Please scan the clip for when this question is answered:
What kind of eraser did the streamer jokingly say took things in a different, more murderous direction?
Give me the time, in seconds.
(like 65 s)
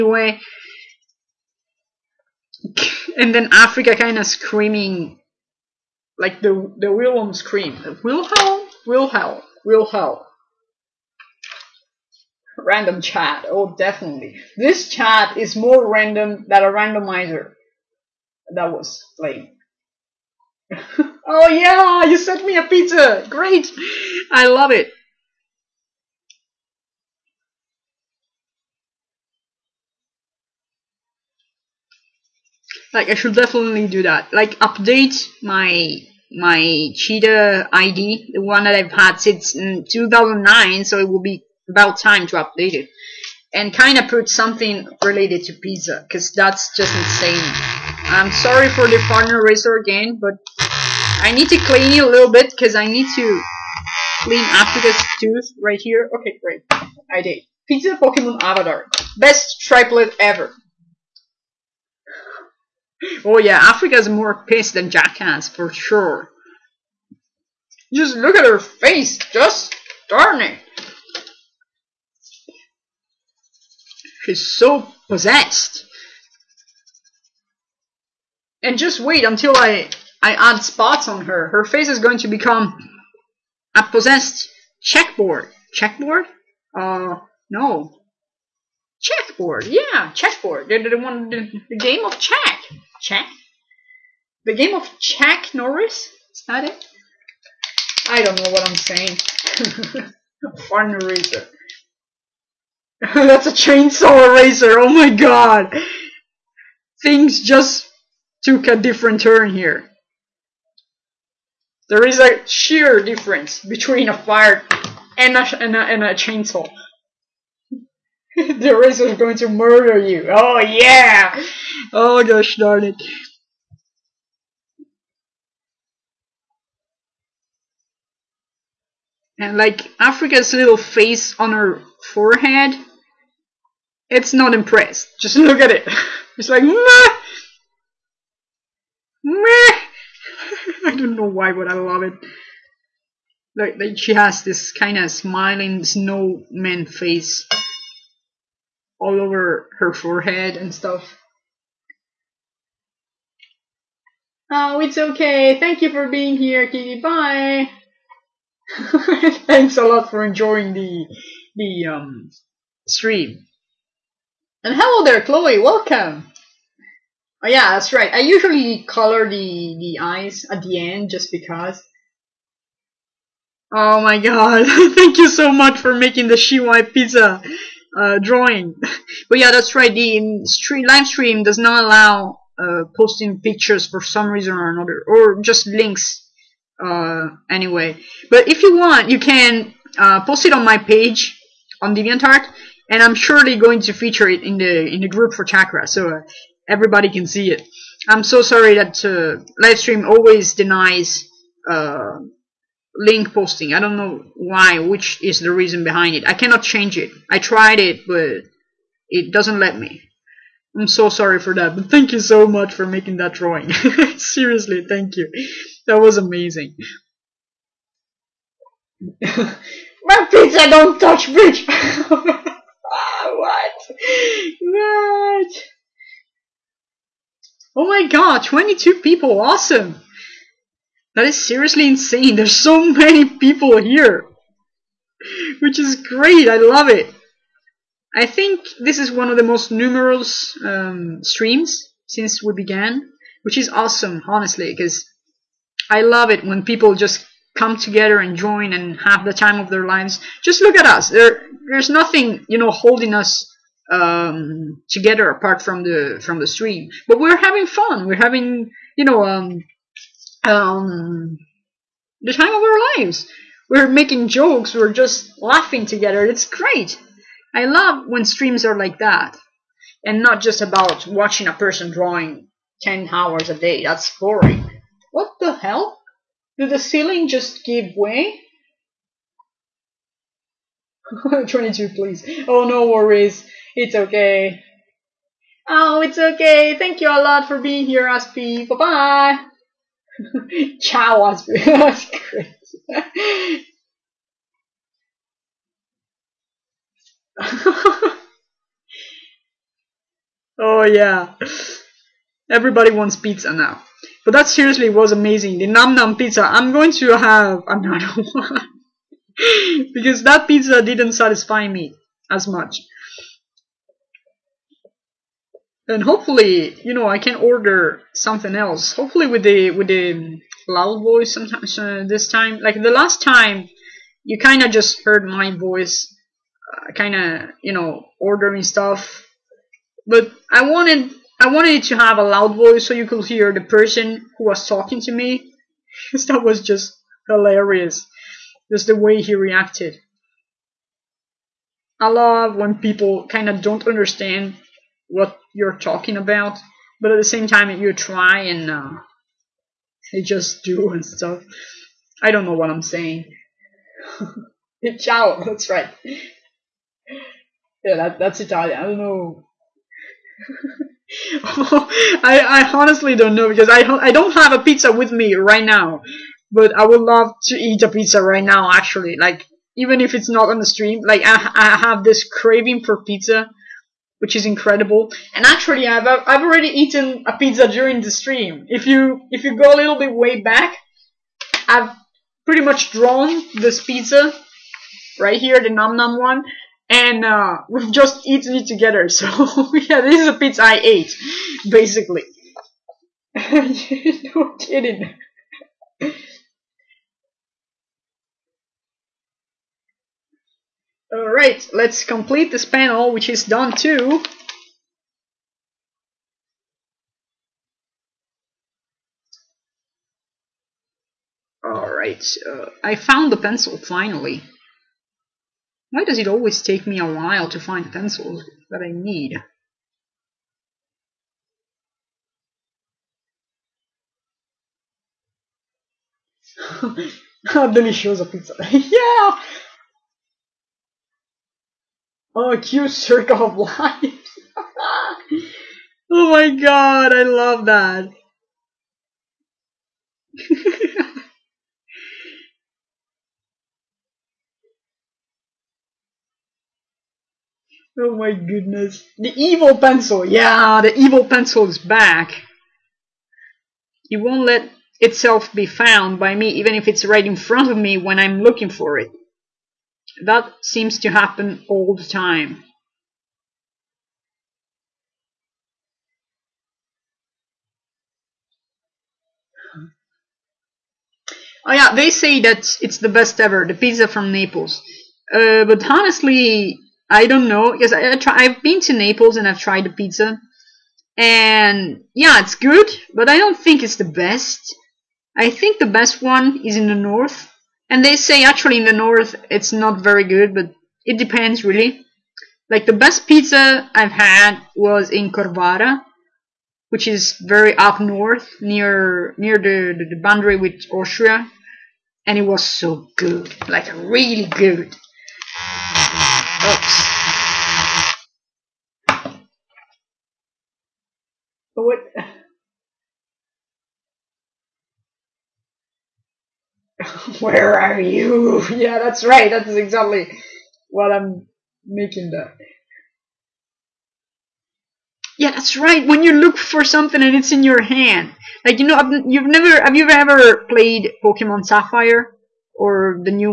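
103 s.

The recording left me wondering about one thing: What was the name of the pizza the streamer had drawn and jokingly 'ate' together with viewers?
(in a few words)
Nam Nam pizza.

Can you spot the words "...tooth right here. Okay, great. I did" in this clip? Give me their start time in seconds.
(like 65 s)
55 s.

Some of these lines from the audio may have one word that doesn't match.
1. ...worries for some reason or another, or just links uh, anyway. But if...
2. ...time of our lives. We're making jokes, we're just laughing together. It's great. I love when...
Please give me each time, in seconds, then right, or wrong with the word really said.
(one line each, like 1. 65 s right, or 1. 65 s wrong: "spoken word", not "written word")
1. 183 s wrong: "pictures", not "worries"
2. 262 s right.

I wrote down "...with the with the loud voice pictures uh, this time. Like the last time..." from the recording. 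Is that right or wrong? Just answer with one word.
wrong.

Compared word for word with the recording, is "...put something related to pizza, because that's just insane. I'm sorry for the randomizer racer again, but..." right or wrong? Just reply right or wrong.
wrong.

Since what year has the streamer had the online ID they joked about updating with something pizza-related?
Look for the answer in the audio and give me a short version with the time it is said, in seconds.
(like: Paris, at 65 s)
2009, at 39 s.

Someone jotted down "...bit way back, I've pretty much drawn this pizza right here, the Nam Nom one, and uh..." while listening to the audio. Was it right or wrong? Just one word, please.
wrong.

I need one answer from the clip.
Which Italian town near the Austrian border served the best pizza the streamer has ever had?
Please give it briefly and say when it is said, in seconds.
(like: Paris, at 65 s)
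Corvara, at 495 s.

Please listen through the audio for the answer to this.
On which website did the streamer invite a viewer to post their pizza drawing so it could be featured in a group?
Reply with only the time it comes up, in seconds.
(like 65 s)
191 s.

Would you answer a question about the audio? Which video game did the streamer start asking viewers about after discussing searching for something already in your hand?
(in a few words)
Pokemon Sapphire.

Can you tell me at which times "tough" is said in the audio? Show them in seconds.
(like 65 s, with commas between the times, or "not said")
not said.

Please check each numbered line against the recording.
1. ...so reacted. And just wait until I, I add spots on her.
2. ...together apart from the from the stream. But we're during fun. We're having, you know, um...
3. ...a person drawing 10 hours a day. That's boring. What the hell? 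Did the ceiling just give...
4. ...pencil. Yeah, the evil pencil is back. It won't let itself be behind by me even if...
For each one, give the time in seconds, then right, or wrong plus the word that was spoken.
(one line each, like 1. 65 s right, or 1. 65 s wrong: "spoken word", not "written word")
1. 74 s wrong: "possessed", not "reacted"
2. 254 s wrong: "having", not "during"
3. 271 s right
4. 449 s wrong: "found", not "behind".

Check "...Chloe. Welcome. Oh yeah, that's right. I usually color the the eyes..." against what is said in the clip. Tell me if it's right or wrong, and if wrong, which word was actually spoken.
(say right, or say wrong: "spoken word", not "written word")
right.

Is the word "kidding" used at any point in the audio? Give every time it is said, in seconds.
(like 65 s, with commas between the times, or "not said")
394 s.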